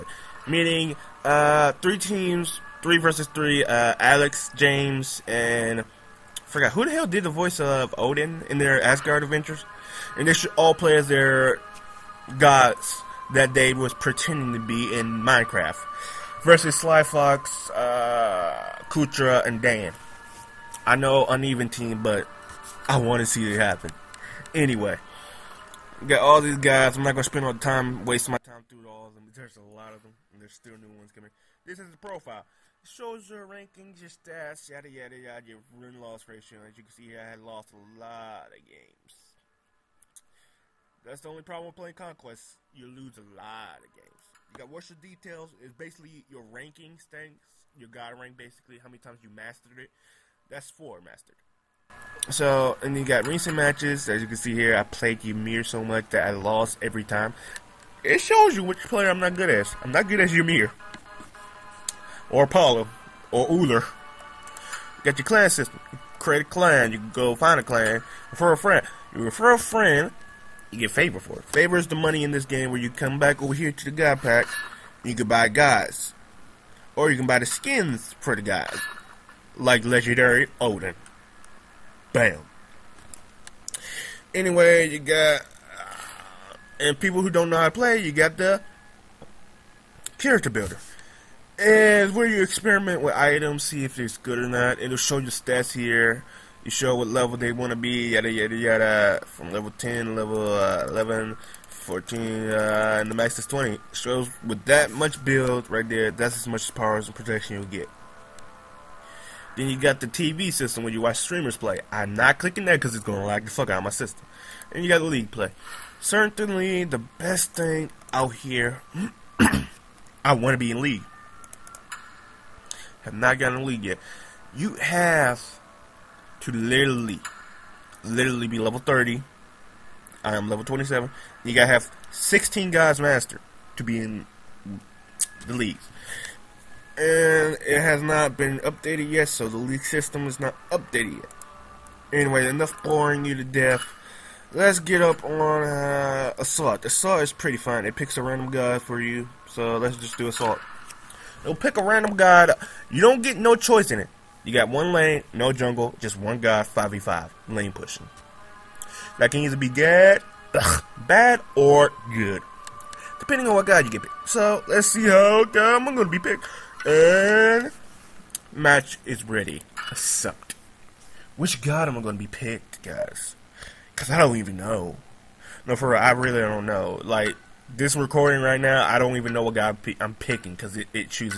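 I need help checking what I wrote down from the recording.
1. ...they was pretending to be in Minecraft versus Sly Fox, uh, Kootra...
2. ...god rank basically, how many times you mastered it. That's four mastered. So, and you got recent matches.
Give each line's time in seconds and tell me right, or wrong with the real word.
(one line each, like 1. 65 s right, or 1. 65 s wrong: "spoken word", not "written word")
1. 13 s right
2. 47 s right.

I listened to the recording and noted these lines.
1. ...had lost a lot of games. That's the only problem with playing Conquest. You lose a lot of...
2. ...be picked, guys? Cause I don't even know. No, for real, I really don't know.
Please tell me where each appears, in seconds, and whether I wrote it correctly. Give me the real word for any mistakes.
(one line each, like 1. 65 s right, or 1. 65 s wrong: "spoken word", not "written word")
1. 37 s right
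2. 172 s right.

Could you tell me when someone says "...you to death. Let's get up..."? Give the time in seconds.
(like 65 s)
143 s.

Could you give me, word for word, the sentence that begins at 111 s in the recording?
I'm not clicking that because it's going to lag the fuck out of my system.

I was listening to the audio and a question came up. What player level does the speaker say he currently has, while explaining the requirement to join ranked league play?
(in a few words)
27.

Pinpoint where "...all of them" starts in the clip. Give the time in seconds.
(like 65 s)
28 s.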